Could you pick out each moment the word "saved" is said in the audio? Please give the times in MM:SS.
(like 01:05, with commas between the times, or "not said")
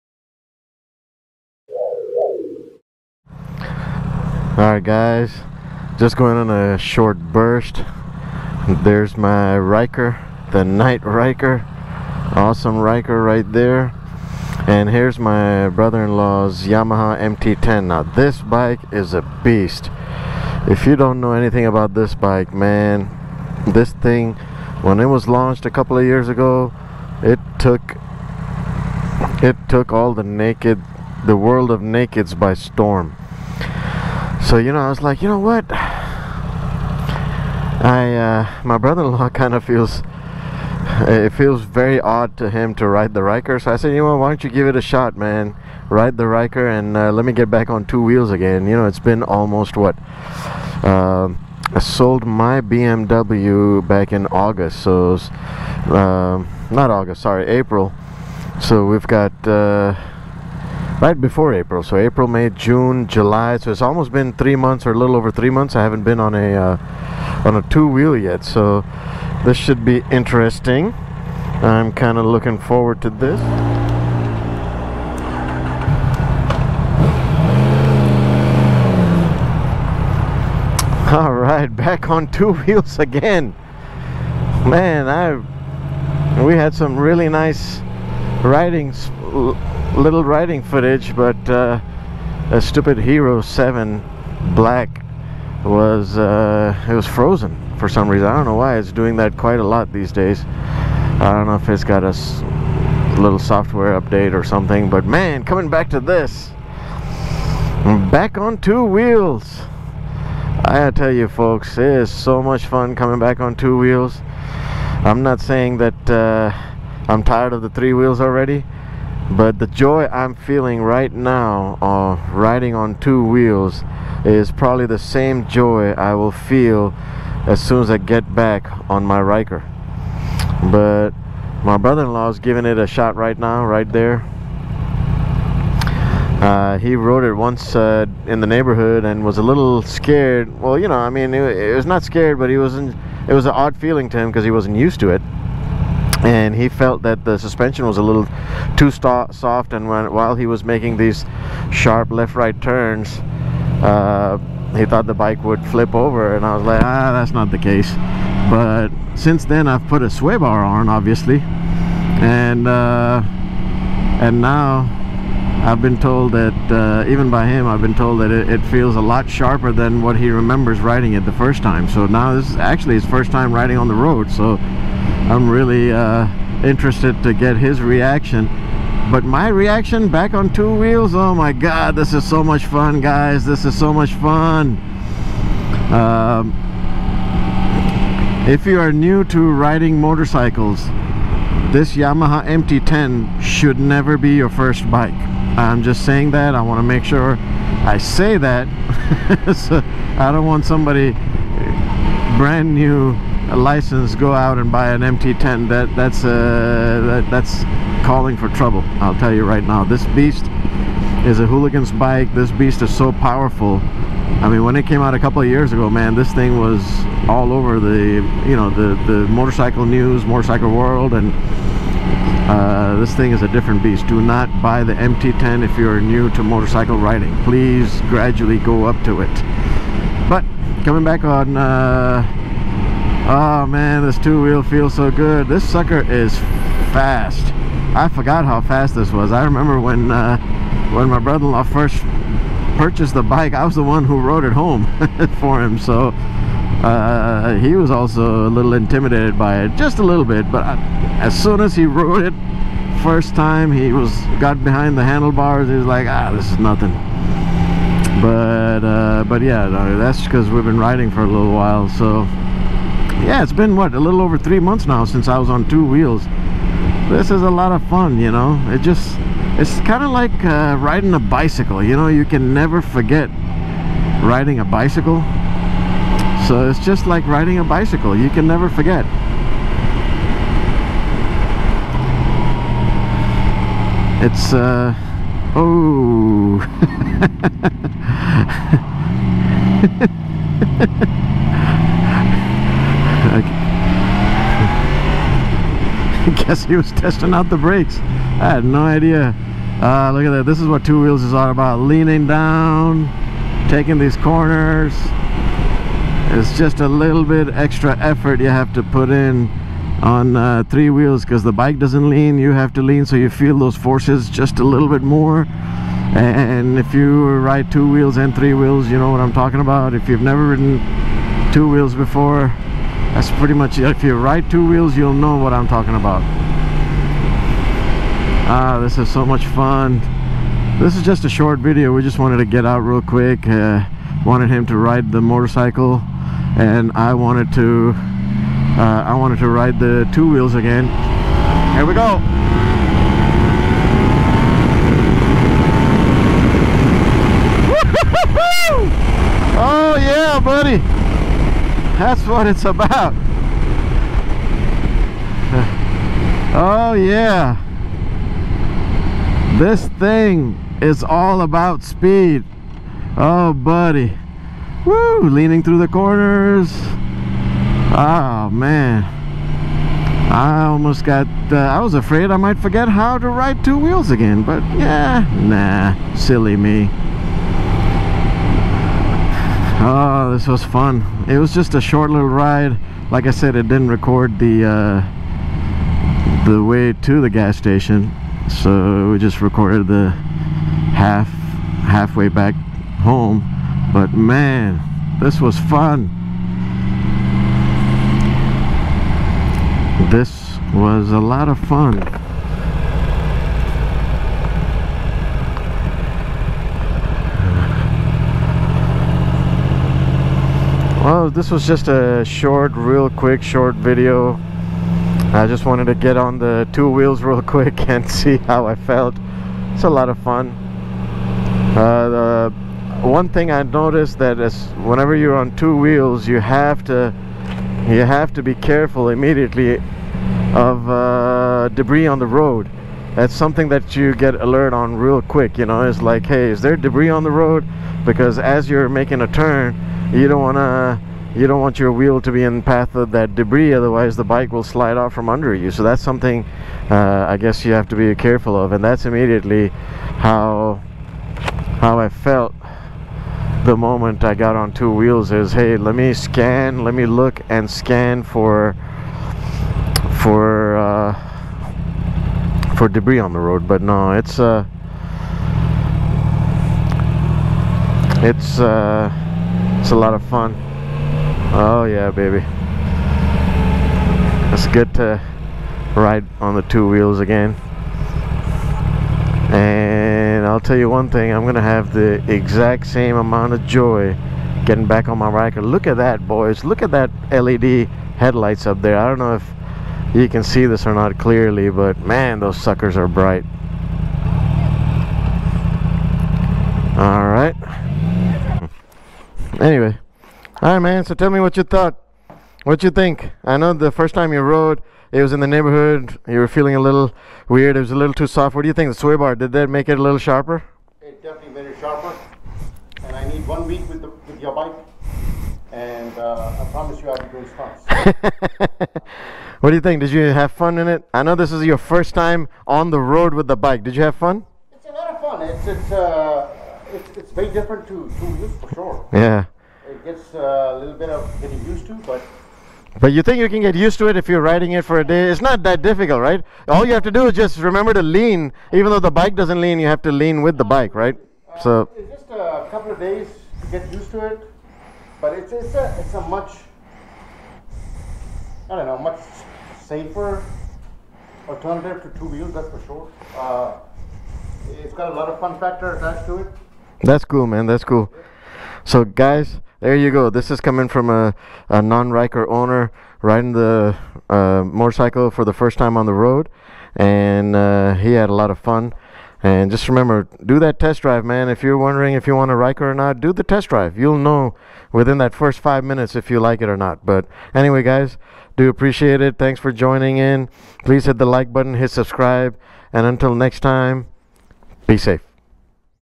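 not said.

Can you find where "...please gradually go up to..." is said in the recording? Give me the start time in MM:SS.
03:47.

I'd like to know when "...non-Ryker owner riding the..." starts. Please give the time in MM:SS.
09:21.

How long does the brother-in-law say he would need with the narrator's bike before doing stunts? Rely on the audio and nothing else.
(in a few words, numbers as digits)
1 week.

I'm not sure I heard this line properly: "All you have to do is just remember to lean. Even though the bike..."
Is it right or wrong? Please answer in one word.
right.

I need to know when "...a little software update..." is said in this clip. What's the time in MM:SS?
01:42.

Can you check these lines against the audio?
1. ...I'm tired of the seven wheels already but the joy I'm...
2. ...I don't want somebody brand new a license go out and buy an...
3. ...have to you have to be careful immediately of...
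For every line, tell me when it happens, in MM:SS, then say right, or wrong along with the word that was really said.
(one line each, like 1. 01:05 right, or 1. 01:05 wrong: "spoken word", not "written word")
1. 01:57 wrong: "three", not "seven"
2. 03:20 right
3. 07:06 right.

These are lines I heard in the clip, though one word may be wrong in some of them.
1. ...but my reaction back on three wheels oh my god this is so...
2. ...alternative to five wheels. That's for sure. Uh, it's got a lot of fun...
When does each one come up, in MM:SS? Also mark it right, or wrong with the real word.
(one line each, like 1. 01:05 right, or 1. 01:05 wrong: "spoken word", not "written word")
1. 02:59 wrong: "two", not "three"
2. 09:11 wrong: "two", not "five".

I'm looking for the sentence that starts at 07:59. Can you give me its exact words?
And I'll tell you one thing, I'm gonna have the exact same amount of joy getting back on my Ryker.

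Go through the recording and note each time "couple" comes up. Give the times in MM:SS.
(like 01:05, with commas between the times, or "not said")
00:25, 03:35, 09:02.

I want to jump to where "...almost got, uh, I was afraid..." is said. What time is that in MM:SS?
06:10.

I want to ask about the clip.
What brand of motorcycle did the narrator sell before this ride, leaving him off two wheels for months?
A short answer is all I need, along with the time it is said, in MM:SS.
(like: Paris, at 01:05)
BMW, at 00:52.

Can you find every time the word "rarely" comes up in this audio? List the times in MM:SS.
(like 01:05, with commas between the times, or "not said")
not said.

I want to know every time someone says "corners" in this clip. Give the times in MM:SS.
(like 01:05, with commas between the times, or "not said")
05:04, 06:05.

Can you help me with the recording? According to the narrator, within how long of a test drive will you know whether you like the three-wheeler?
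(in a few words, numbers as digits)
5 minutes.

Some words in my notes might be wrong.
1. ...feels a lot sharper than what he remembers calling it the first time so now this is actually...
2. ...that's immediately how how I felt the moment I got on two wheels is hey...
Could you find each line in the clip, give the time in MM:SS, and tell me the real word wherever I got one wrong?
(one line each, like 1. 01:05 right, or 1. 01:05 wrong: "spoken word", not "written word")
1. 02:48 wrong: "riding", not "calling"
2. 07:28 right.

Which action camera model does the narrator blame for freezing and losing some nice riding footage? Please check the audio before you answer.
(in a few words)
Hero 7 Black.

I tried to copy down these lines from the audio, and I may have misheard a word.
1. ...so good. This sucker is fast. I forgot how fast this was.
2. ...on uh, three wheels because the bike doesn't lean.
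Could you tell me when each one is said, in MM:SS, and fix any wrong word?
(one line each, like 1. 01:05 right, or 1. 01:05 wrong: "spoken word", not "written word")
1. 03:54 right
2. 05:10 right.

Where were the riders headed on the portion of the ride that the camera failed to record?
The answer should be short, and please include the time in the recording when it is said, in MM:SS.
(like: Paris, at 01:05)
Gas station, at 06:27.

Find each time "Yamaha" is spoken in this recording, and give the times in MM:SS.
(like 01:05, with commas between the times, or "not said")
00:16, 03:11.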